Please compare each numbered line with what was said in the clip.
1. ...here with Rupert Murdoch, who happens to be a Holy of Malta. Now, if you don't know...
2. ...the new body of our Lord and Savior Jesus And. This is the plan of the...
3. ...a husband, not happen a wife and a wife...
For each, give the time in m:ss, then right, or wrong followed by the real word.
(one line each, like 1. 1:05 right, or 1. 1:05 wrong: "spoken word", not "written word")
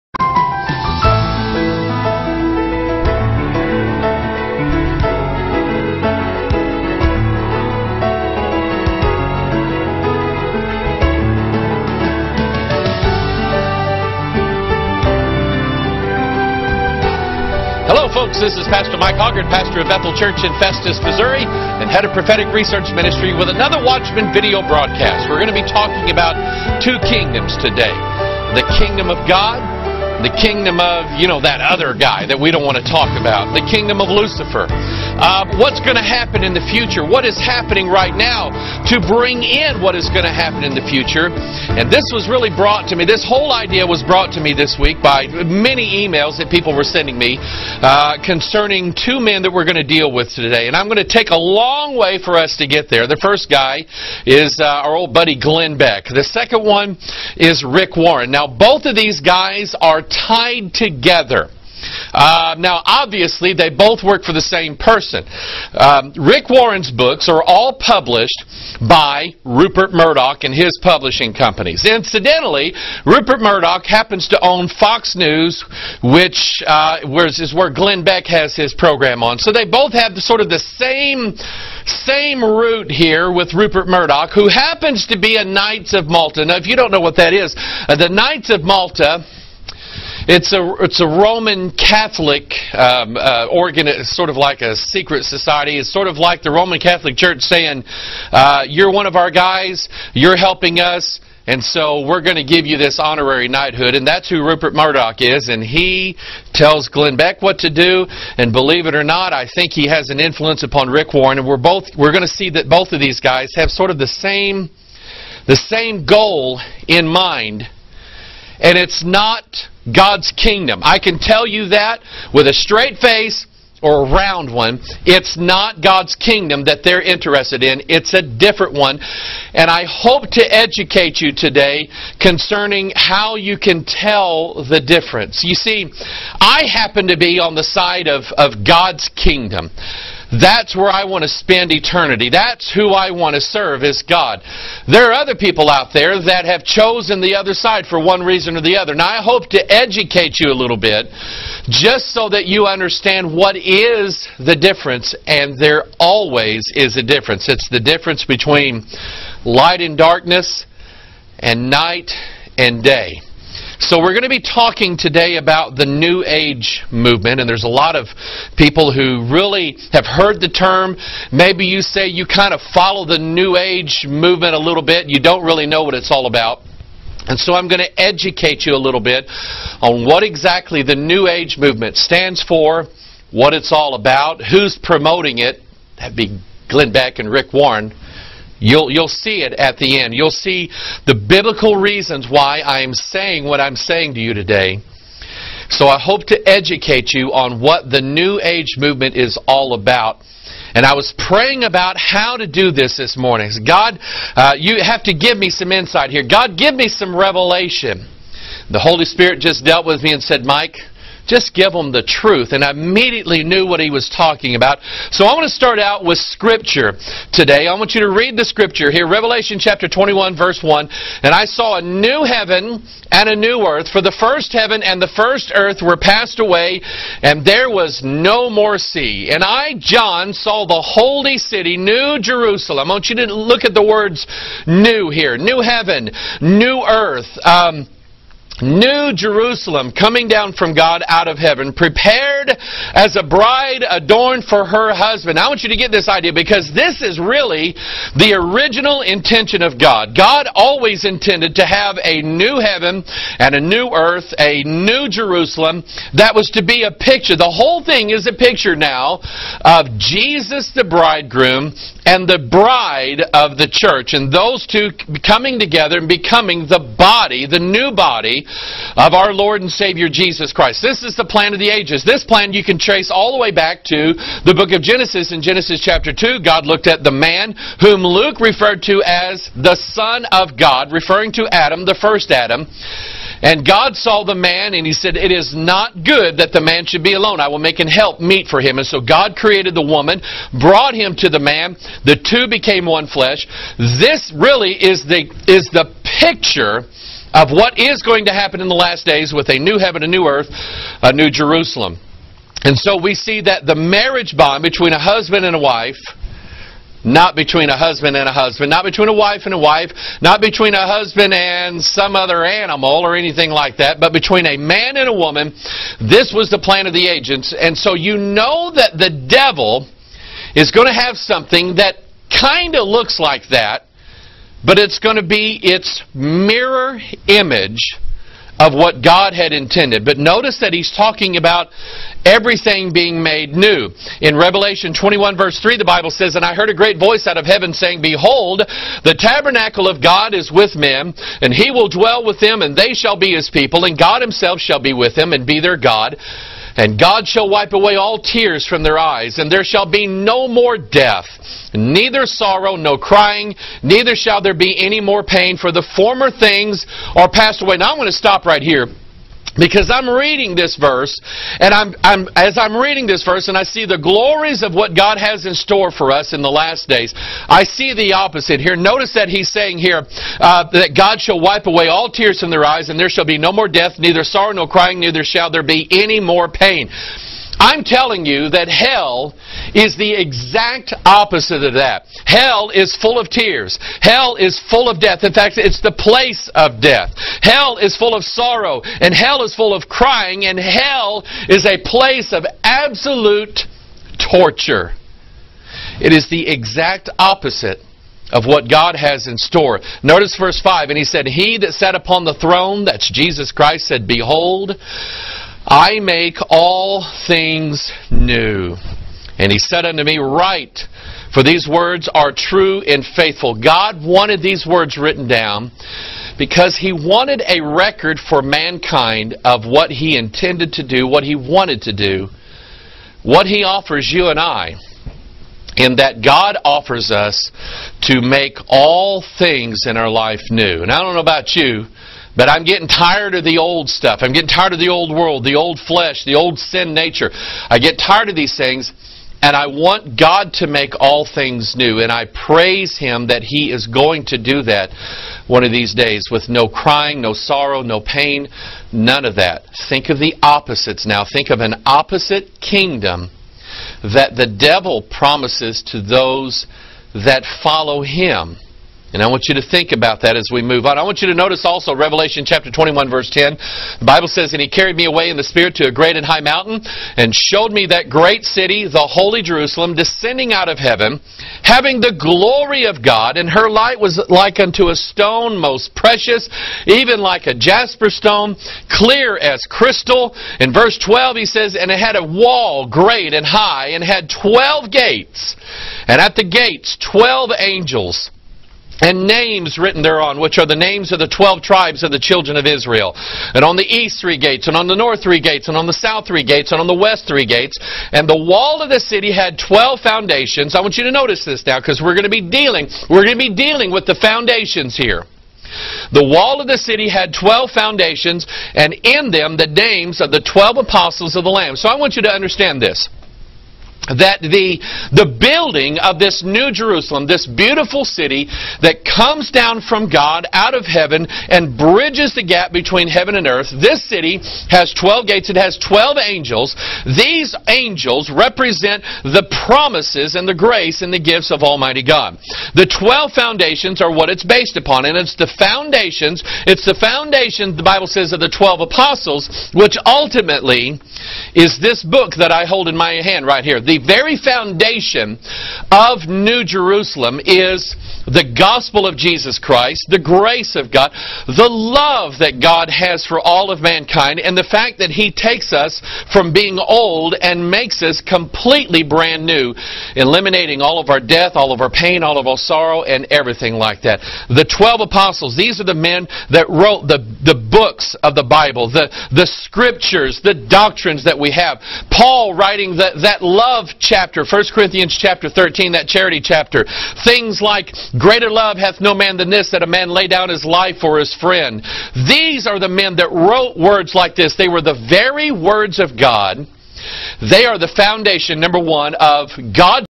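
1. 1:22 wrong: "Knights", not "Holy"
2. 4:27 wrong: "Christ", not "And"
3. 5:08 wrong: "between", not "happen".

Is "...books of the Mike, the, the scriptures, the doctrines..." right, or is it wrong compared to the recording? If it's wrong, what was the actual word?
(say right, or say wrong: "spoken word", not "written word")
wrong: "Bible", not "Mike".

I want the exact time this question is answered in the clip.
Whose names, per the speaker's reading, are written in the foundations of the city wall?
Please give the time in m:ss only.
8:30.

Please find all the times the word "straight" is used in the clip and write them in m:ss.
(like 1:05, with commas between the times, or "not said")
2:02.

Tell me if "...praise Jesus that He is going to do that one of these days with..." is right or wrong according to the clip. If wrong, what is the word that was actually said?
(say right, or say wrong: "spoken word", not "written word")
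wrong: "Him", not "Jesus".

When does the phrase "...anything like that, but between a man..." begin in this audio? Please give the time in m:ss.
5:13.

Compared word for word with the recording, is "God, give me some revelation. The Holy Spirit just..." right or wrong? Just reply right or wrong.
right.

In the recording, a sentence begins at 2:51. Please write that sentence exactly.
Maybe you say you kind of follow the New Age movement a little bit, you don't really know what it's all about.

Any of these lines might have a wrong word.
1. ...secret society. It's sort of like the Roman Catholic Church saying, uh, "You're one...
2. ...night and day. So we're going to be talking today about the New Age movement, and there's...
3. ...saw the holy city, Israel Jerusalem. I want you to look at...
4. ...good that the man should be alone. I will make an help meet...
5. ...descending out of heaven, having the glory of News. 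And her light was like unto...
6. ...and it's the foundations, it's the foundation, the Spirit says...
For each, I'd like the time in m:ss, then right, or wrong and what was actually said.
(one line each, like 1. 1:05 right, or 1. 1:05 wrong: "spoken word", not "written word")
1. 1:34 right
2. 2:41 right
3. 3:50 wrong: "New", not "Israel"
4. 4:46 right
5. 7:49 wrong: "God", not "News"
6. 8:55 wrong: "Bible", not "Spirit".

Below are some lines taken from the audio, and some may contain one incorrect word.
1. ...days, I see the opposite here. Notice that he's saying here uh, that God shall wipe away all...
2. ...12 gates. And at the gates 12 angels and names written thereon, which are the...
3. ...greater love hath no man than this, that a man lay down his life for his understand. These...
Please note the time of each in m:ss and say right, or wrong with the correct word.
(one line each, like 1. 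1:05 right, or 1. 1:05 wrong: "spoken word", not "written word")
1. 6:06 right
2. 8:04 right
3. 9:38 wrong: "friend", not "understand".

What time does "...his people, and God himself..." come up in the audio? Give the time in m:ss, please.
5:43.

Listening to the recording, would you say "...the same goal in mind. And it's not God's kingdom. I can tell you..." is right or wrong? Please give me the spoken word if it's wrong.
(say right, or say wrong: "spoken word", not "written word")
right.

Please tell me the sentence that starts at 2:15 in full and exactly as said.
You see, I happen to be on the side of, of God's kingdom.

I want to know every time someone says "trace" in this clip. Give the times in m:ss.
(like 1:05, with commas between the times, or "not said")
4:32.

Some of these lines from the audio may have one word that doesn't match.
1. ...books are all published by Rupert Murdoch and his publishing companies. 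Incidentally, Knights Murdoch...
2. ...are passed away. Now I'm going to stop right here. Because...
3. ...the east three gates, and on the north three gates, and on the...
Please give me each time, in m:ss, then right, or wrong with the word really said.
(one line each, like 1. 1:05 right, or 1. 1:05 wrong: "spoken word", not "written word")
1. 1:06 wrong: "Rupert", not "Knights"
2. 5:57 right
3. 8:13 right.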